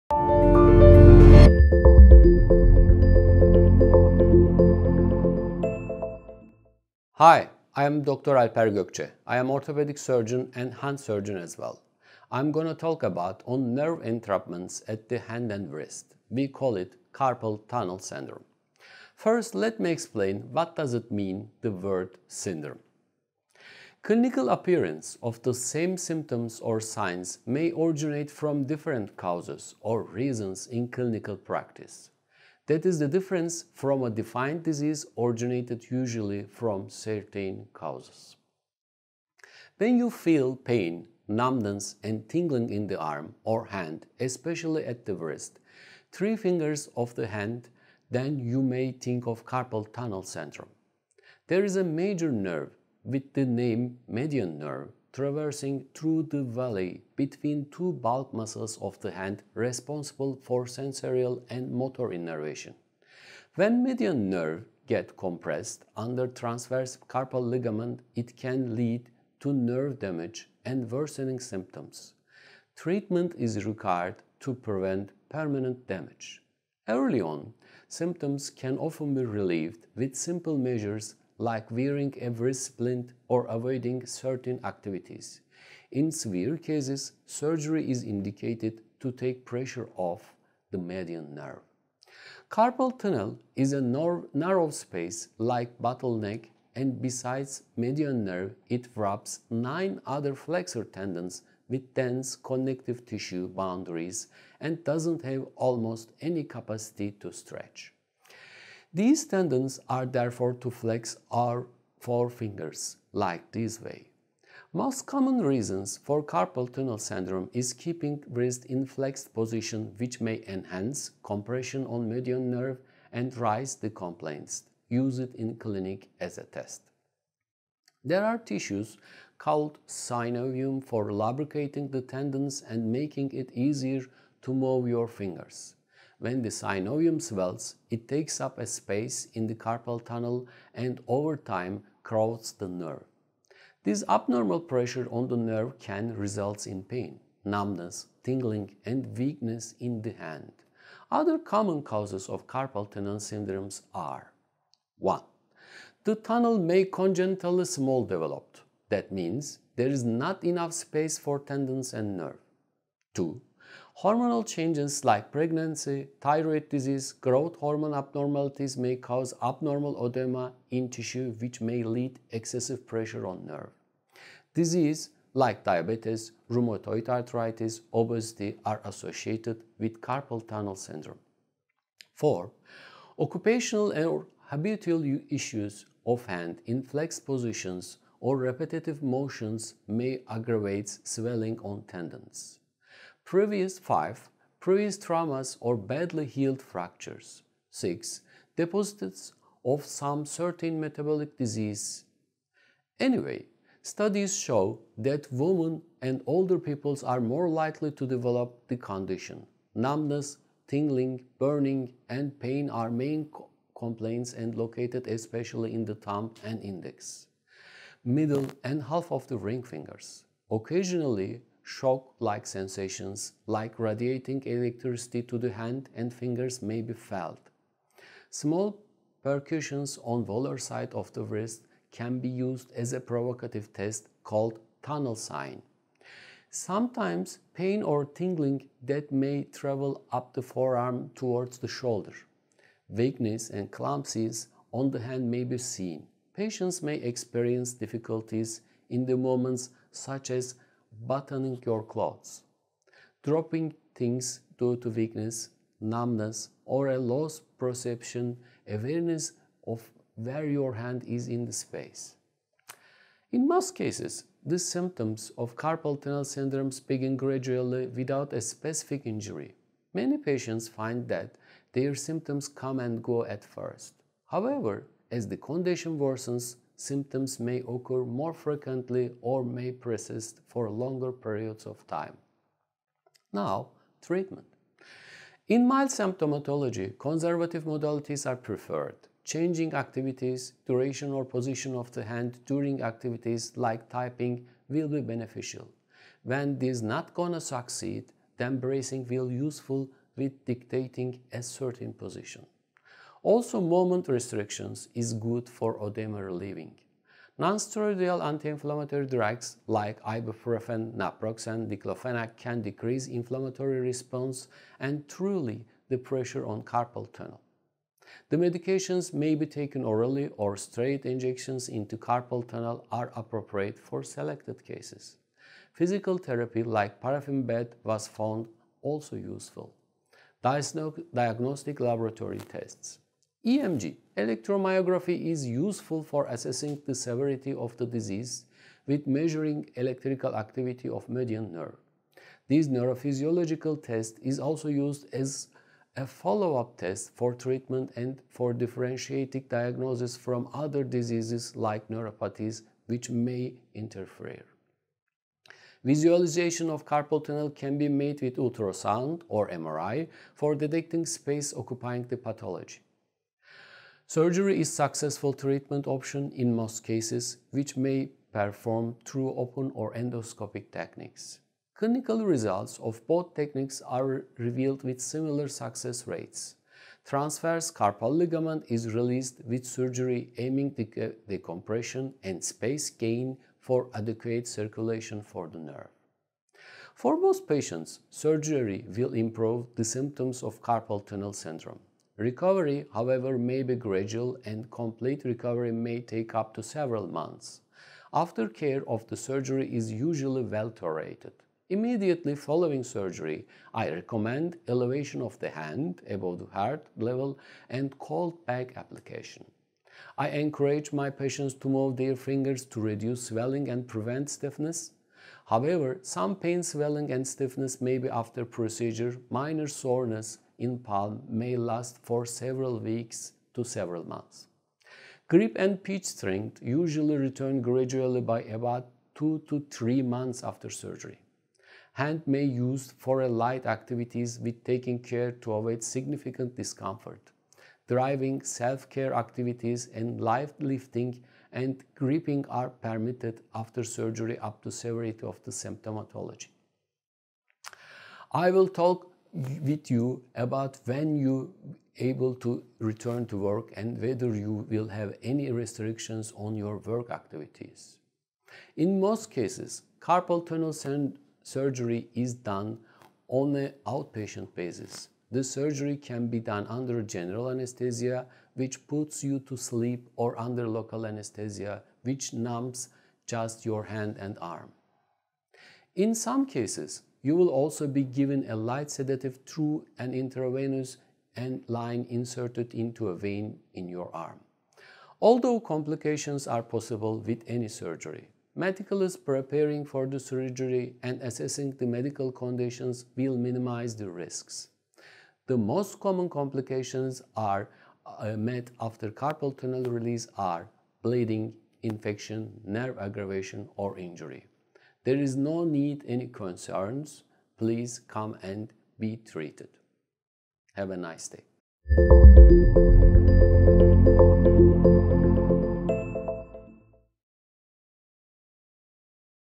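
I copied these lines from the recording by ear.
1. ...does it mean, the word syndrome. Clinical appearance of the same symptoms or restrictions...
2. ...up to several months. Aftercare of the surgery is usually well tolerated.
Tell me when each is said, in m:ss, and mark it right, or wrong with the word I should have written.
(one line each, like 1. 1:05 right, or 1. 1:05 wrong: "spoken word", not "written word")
1. 0:20 wrong: "signs", not "restrictions"
2. 6:36 right.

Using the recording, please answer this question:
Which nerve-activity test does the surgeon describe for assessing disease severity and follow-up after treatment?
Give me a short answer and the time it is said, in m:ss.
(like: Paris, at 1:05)
electromyography, at 5:34.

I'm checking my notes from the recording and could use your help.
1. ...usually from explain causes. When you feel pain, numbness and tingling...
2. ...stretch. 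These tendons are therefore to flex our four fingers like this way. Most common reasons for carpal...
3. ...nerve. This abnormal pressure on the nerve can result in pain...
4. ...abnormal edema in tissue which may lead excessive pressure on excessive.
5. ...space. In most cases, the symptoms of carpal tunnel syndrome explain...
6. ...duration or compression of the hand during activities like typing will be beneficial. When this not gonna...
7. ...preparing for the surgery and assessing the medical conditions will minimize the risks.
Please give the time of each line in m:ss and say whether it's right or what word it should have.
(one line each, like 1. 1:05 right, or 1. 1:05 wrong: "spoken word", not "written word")
1. 0:35 wrong: "certain", not "explain"
2. 1:47 right
3. 2:22 right
4. 2:49 wrong: "nerve", not "excessive"
5. 4:21 wrong: "begin", not "explain"
6. 4:50 wrong: "position", not "compression"
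7. 8:09 right.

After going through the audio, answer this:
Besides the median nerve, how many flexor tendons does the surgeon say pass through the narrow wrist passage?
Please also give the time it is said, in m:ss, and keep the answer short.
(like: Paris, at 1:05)
9, at 1:39.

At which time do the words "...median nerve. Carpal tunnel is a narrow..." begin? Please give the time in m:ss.
1:30.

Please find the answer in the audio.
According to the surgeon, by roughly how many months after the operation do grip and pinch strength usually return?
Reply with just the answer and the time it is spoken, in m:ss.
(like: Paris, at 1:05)
2 to 3 months, at 7:09.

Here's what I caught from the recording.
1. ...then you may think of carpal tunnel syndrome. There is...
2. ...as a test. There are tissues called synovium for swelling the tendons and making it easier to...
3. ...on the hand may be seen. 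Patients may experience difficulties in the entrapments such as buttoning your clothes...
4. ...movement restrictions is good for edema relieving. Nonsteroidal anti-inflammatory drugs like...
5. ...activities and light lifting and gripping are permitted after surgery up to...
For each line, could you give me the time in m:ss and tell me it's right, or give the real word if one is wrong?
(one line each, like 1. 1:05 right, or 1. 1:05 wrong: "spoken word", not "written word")
1. 0:48 right
2. 2:06 wrong: "lubricating", not "swelling"
3. 4:04 wrong: "moments", not "entrapments"
4. 5:03 right
5. 7:19 right.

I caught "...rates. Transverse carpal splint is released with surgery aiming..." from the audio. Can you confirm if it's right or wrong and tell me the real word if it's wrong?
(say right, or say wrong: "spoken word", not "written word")
wrong: "ligament", not "splint".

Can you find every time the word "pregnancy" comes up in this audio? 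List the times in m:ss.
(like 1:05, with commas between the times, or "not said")
2:45.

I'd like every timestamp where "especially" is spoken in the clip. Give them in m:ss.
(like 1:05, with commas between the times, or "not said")
0:44, 3:35.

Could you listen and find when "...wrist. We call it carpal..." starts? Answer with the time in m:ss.
0:15.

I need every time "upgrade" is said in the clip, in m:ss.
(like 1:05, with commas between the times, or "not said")
not said.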